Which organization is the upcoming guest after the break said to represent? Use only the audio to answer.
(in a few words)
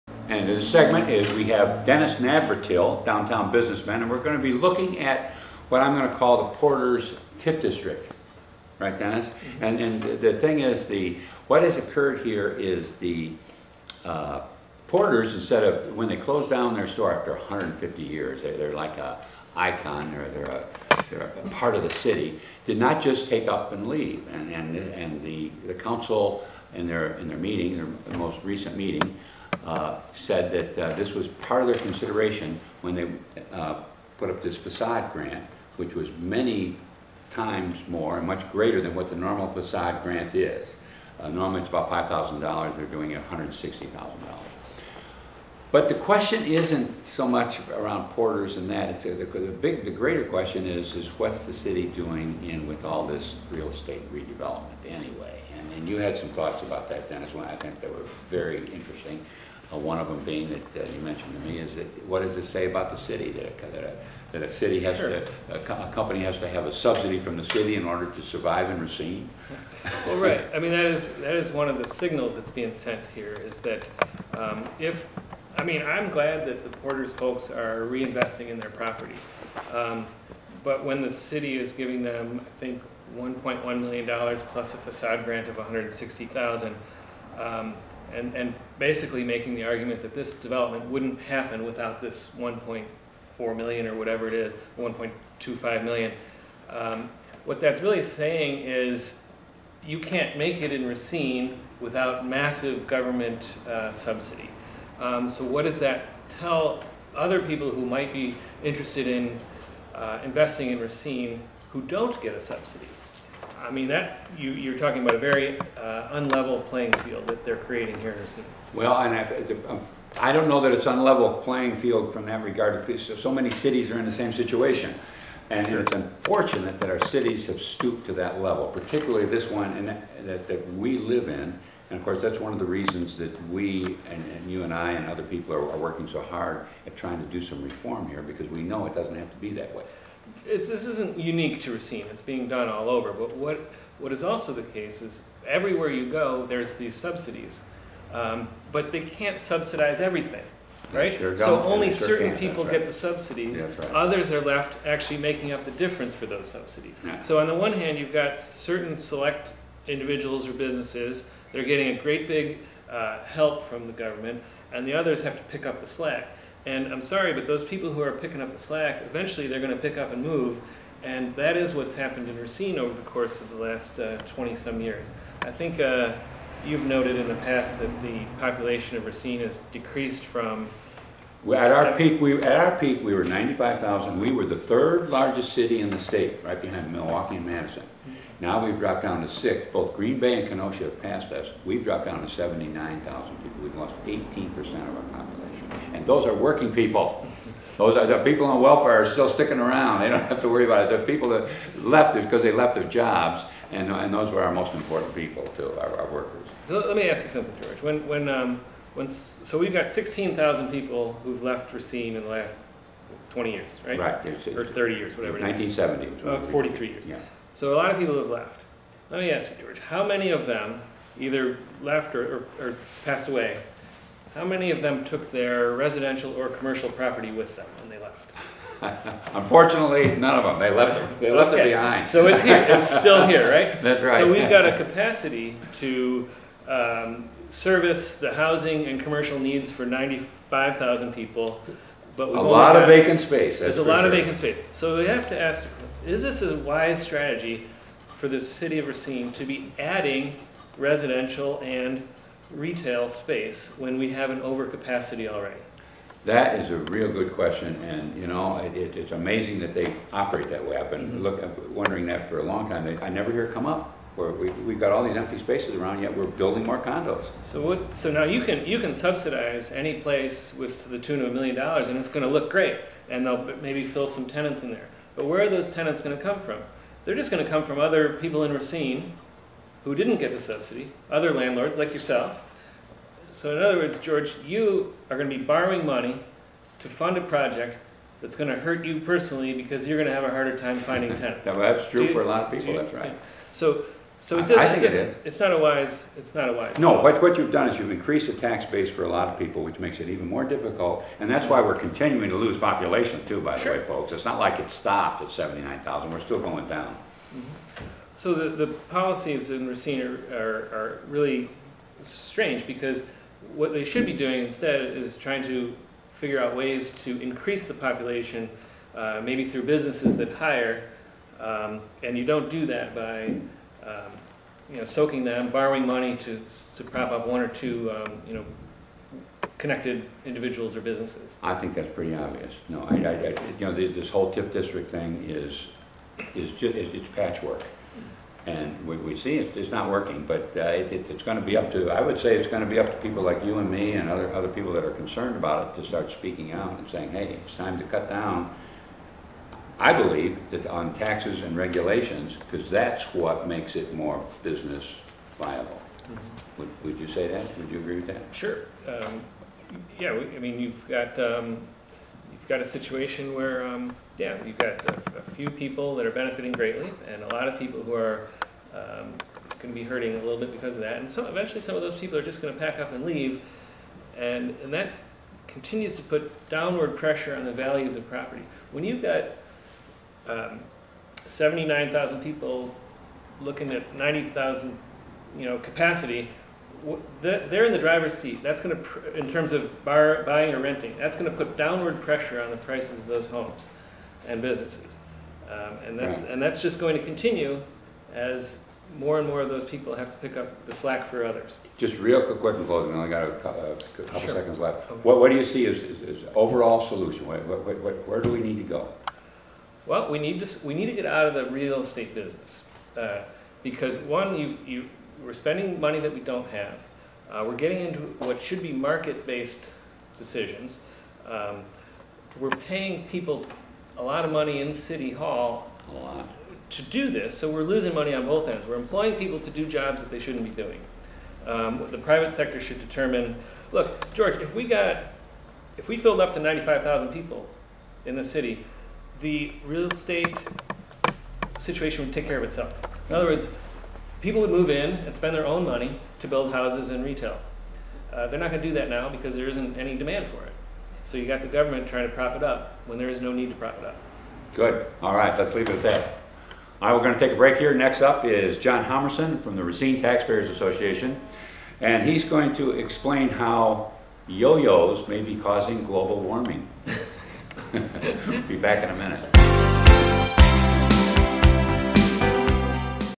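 Racine Taxpayers Association.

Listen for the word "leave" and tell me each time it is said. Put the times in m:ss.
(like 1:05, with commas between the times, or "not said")
0:23, 6:13, 7:35.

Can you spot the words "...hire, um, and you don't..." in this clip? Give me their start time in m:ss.
5:20.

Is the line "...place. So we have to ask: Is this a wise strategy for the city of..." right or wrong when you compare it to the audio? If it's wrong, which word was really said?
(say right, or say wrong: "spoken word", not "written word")
wrong: "space", not "place".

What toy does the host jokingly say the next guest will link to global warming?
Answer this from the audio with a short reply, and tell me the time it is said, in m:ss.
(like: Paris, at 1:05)
yo-yos, at 7:44.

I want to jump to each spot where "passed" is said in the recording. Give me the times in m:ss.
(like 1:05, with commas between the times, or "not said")
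3:11, 3:43.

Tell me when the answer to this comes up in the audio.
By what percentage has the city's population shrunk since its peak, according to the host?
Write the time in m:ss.
3:14.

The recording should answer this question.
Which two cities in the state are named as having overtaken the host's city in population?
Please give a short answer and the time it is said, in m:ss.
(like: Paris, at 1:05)
Green Bay and Kenosha, at 3:09.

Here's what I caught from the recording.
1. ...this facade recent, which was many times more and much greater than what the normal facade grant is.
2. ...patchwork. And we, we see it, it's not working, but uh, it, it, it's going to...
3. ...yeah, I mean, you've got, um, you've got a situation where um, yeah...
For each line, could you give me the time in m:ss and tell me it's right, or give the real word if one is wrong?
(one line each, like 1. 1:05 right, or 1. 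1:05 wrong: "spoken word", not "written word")
1. 0:34 wrong: "grant", not "recent"
2. 5:37 right
3. 5:59 right.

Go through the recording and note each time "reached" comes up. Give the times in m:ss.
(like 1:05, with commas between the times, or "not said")
not said.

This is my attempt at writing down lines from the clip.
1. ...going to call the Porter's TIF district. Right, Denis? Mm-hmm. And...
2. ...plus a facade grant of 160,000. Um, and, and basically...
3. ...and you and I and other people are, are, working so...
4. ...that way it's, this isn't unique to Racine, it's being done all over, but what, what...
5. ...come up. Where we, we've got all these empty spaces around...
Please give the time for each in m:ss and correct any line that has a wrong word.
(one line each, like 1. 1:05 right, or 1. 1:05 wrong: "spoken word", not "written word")
1. 0:05 right
2. 1:24 right
3. 2:14 right
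4. 2:19 right
5. 4:23 right.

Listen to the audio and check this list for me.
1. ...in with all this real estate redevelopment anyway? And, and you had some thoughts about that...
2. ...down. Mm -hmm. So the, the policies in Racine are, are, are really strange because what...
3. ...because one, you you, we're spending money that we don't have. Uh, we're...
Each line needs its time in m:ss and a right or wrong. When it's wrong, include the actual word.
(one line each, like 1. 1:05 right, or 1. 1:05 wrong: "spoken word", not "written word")
1. 0:52 right
2. 5:06 right
3. 6:53 right.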